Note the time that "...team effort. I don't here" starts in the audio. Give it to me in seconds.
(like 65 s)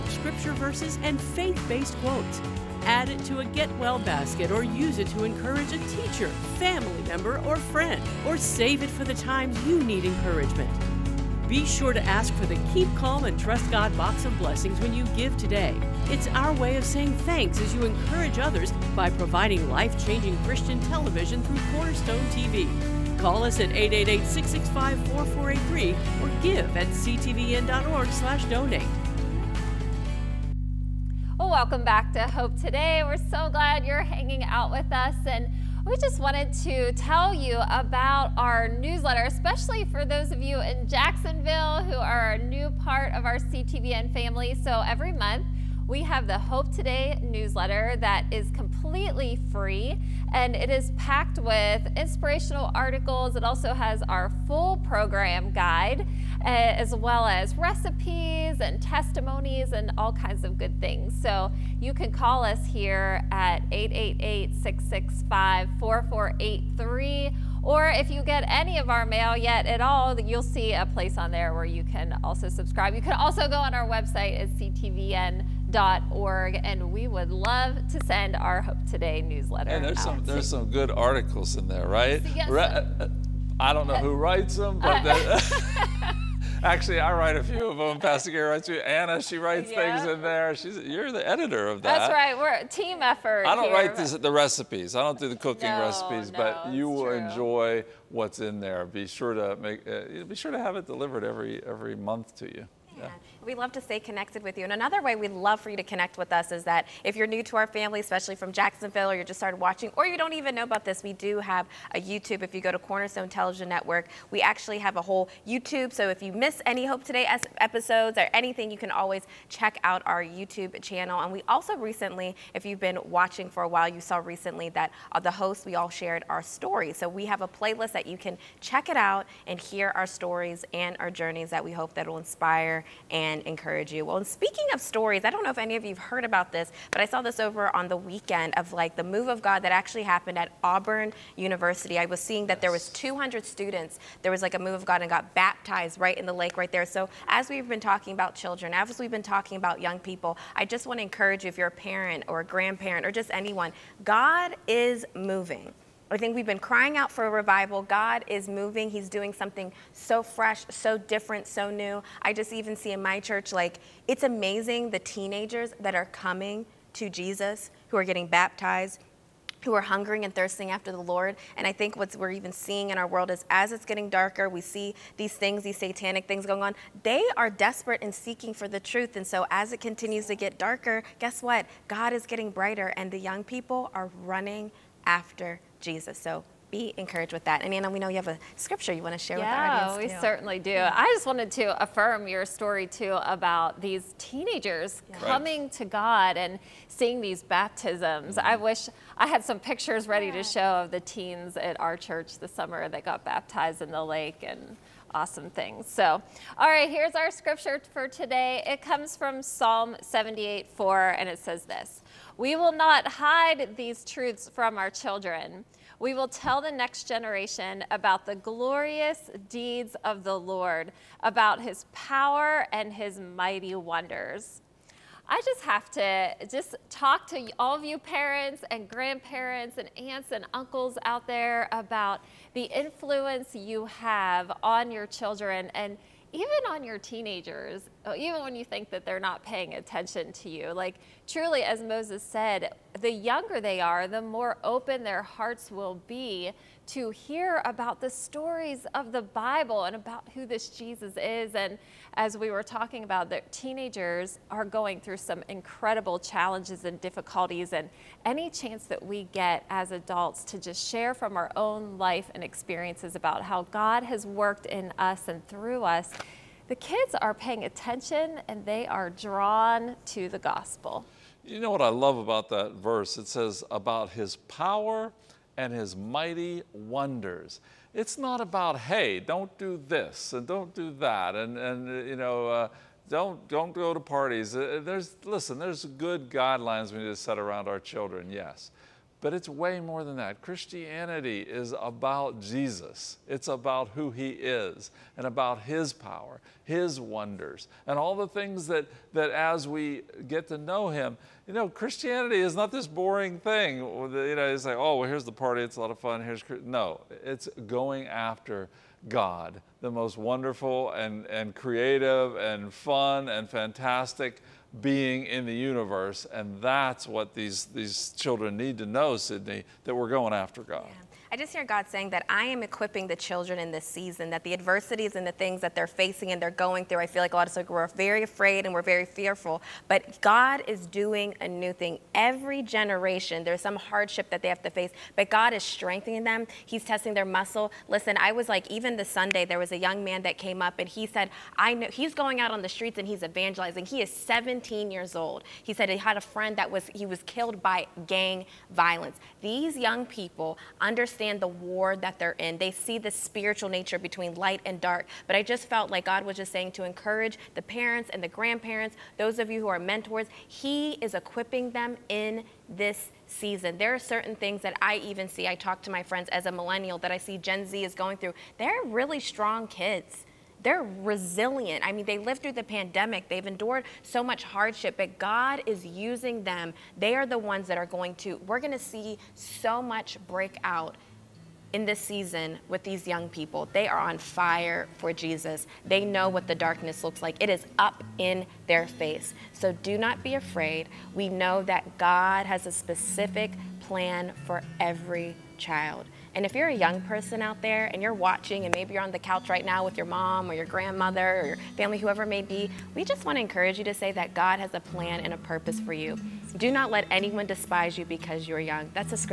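92 s.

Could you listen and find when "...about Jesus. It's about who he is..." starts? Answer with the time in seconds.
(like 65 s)
291 s.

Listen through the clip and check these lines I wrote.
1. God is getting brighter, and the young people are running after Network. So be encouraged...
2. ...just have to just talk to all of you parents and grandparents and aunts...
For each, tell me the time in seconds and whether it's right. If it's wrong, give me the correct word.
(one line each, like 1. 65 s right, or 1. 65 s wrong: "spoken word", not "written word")
1. 181 s wrong: "Jesus", not "Network"
2. 225 s right.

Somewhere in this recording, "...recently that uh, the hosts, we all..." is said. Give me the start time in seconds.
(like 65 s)
124 s.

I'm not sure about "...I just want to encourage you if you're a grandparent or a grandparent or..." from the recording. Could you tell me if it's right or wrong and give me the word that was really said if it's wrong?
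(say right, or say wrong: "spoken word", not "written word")
wrong: "parent", not "grandparent".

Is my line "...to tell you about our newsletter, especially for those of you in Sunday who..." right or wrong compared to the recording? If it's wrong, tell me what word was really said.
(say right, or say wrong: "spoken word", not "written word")
wrong: "Jacksonville", not "Sunday".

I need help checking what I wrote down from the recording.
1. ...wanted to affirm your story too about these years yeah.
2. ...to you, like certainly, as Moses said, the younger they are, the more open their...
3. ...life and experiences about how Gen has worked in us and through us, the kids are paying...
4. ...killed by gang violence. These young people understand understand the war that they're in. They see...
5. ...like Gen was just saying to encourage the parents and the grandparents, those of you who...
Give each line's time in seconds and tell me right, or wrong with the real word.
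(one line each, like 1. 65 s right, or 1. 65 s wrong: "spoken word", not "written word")
1. 191 s wrong: "teenagers", not "years"
2. 240 s wrong: "truly", not "certainly"
3. 261 s wrong: "God", not "Gen"
4. 347 s right
5. 355 s wrong: "God", not "Gen".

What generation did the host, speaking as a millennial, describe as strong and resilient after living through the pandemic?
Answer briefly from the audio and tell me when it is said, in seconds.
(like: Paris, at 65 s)
Gen Z, at 367 s.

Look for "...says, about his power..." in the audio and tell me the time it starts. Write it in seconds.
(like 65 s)
273 s.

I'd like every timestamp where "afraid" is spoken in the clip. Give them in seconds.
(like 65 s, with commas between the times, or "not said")
328 s, 390 s.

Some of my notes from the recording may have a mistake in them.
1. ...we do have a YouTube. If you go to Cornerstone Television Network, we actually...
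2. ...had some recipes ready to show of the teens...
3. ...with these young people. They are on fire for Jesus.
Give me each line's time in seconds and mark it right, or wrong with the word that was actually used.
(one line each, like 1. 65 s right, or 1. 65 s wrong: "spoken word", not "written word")
1. 111 s right
2. 199 s wrong: "pictures", not "recipes"
3. 382 s right.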